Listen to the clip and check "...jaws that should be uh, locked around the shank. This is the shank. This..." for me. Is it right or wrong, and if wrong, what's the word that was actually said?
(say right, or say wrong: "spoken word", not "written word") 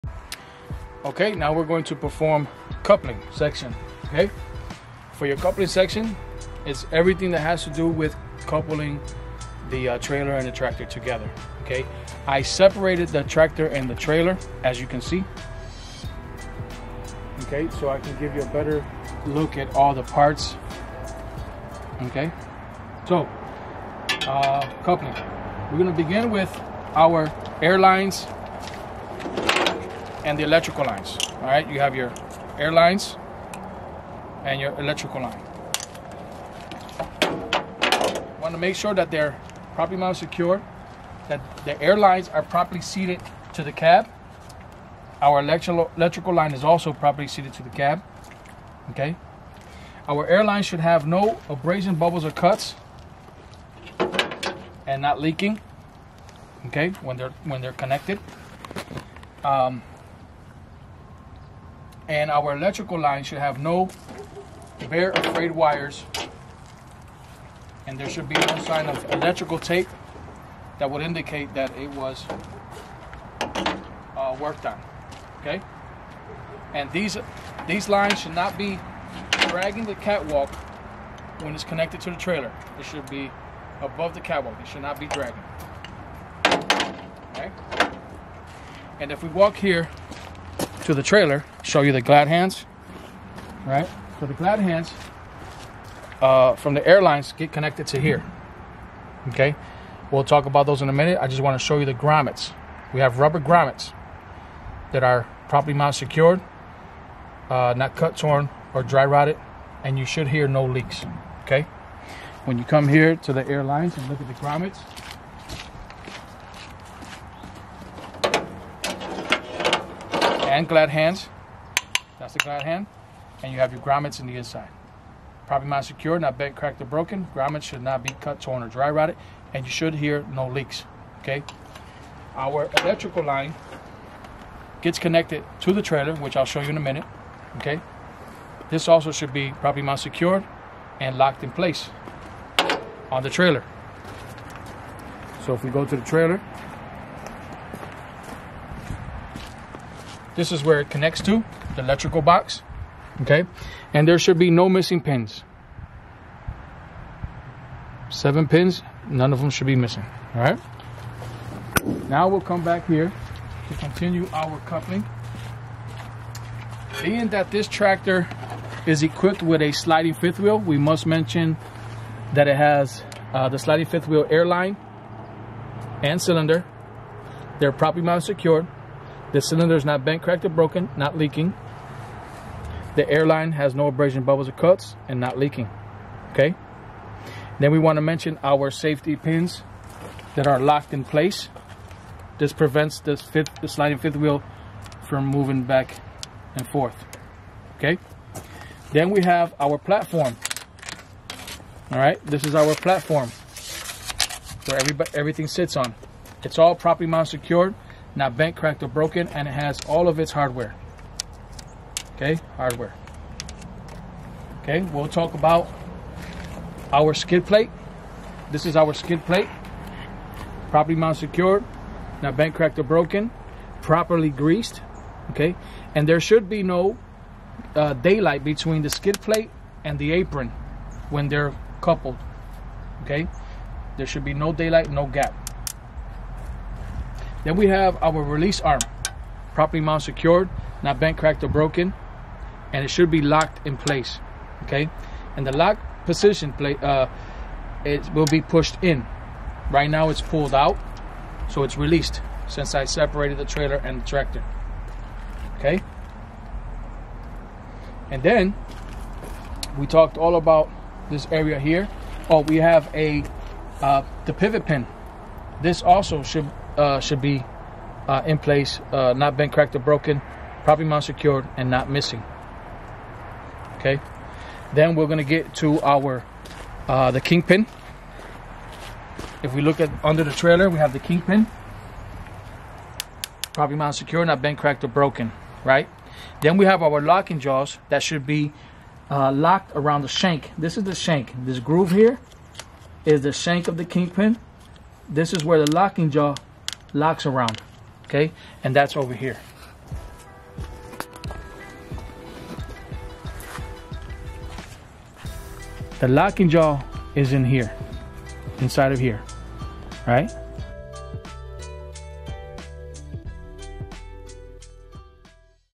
right.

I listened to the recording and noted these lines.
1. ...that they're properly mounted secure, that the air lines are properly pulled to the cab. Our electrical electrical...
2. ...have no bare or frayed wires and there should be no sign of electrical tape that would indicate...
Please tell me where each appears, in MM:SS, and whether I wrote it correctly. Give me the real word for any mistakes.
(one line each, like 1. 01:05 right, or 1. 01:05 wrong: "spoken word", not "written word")
1. 00:38 wrong: "seated", not "pulled"
2. 01:03 right.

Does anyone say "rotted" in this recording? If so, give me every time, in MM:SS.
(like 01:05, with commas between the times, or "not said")
01:49, 02:08.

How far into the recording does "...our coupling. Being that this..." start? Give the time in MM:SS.
02:44.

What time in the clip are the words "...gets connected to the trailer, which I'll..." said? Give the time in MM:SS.
02:14.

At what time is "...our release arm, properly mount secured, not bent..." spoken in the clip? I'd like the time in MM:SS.
03:58.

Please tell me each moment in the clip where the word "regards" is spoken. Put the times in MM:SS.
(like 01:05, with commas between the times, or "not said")
not said.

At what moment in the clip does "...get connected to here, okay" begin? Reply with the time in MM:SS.
01:37.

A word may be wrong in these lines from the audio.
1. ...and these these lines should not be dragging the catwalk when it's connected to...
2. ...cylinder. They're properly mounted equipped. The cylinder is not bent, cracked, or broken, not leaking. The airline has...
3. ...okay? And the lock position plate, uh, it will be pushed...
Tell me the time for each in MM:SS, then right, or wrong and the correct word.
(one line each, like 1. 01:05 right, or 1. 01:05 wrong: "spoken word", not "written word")
1. 01:16 right
2. 02:56 wrong: "secured", not "equipped"
3. 04:04 right.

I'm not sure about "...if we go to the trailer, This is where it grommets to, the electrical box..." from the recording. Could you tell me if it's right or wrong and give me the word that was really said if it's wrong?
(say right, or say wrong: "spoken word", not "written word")
wrong: "connects", not "grommets".